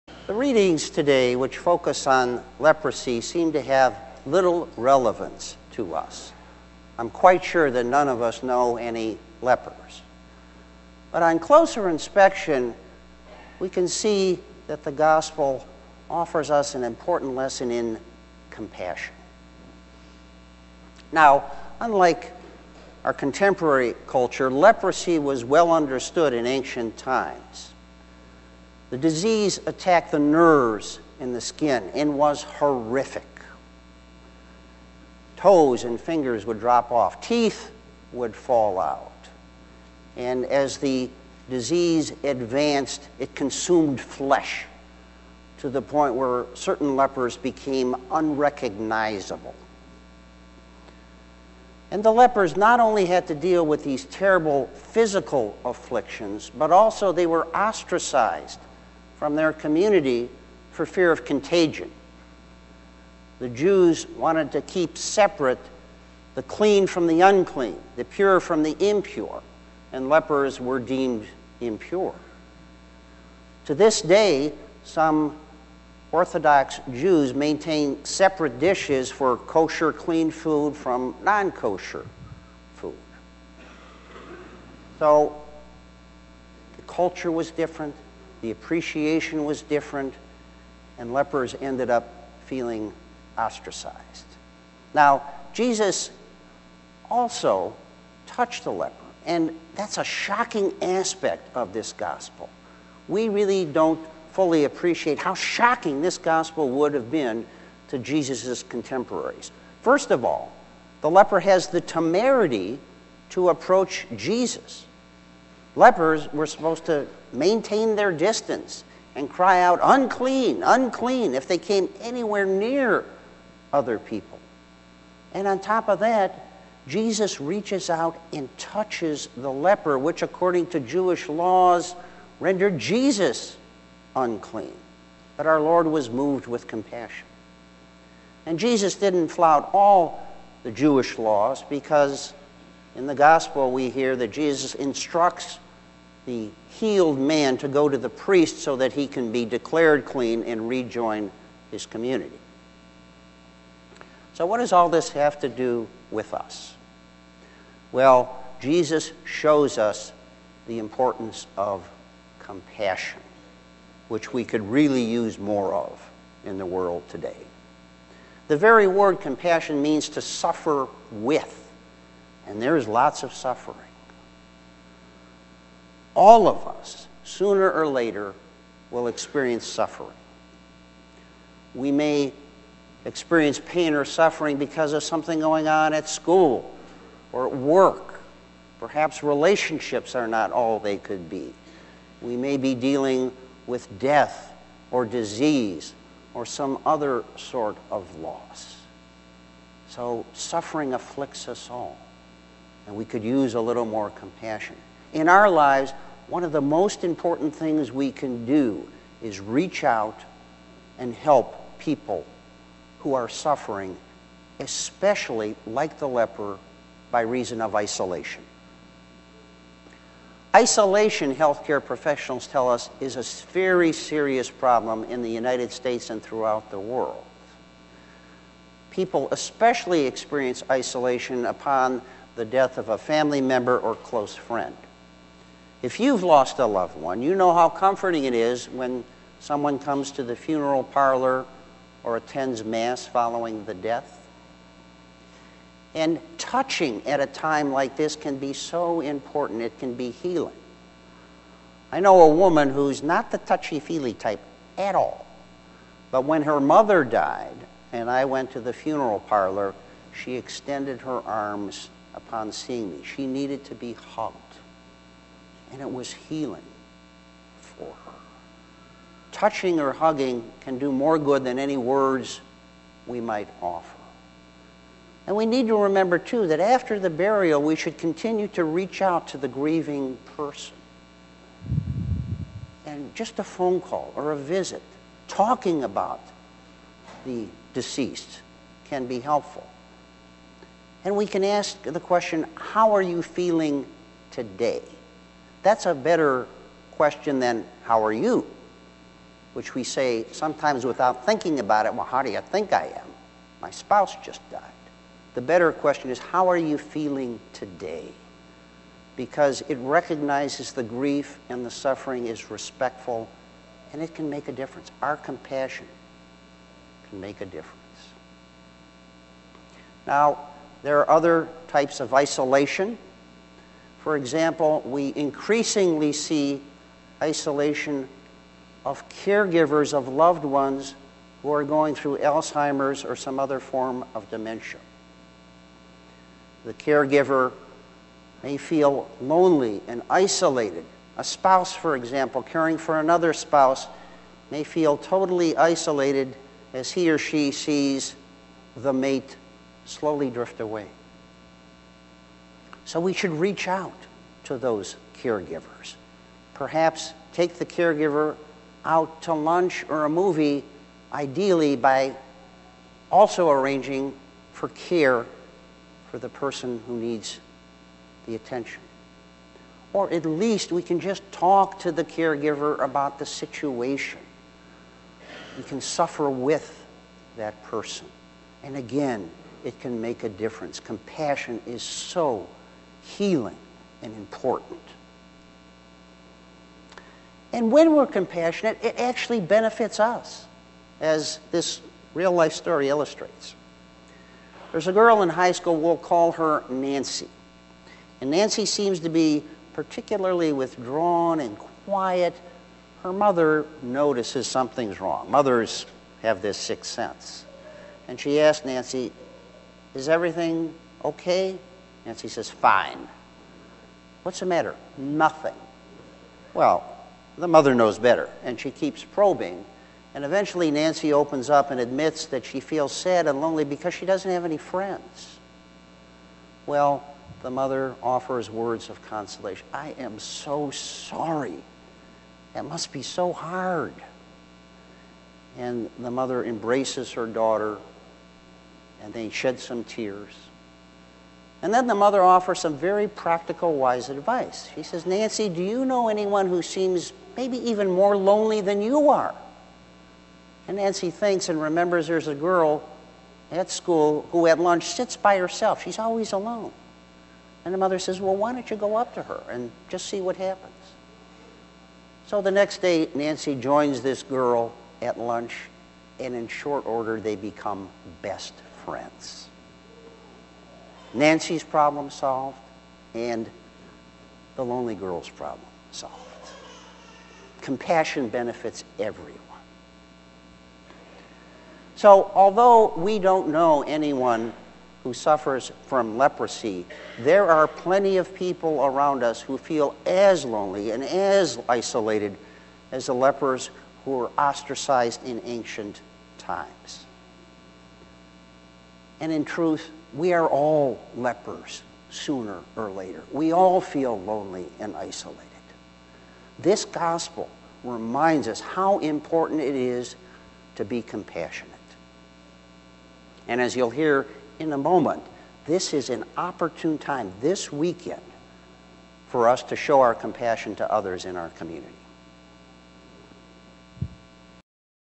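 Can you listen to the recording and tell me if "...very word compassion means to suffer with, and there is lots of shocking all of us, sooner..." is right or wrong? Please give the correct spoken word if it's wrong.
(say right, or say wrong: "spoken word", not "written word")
wrong: "suffering", not "shocking".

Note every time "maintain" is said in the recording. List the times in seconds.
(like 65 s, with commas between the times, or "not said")
77 s, 117 s.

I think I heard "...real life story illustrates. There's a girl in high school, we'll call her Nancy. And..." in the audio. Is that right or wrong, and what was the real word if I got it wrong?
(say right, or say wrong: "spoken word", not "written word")
right.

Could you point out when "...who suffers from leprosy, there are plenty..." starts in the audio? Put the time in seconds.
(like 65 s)
485 s.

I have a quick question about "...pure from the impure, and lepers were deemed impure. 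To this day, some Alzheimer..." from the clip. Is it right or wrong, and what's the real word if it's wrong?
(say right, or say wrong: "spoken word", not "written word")
wrong: "Orthodox", not "Alzheimer".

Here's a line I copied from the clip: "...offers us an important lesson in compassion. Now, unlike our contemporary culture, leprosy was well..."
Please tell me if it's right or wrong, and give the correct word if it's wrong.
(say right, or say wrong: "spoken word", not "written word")
right.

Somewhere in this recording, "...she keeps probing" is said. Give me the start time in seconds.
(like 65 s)
418 s.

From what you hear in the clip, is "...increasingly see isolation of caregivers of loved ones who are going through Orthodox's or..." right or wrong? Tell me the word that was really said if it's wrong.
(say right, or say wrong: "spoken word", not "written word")
wrong: "Alzheimer", not "Orthodox".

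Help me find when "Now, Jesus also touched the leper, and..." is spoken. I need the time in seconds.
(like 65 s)
94 s.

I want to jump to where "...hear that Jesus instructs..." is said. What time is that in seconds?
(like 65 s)
143 s.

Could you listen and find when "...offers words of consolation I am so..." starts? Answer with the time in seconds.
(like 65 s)
428 s.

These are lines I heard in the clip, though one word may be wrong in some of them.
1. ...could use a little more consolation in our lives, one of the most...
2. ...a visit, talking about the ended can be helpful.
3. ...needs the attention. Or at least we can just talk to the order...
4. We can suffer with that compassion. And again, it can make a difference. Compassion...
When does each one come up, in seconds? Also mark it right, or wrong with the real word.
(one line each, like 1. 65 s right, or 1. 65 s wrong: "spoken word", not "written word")
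1. 203 s wrong: "compassion", not "consolation"
2. 284 s wrong: "deceased", not "ended"
3. 366 s wrong: "caregiver", not "order"
4. 375 s wrong: "person", not "compassion".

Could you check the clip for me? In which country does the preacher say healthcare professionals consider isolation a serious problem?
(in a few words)
United States.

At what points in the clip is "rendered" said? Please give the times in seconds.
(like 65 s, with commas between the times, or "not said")
132 s.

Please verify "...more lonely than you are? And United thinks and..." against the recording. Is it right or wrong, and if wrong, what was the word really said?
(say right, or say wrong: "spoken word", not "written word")
wrong: "Nancy", not "United".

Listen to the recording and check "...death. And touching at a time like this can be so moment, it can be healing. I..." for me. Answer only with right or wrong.
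wrong.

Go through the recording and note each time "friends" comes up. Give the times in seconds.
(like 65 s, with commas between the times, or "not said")
234 s, 424 s, 468 s.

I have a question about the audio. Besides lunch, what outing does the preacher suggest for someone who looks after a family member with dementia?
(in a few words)
a movie.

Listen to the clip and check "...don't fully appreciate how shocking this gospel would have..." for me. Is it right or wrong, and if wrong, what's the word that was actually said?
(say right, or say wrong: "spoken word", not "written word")
right.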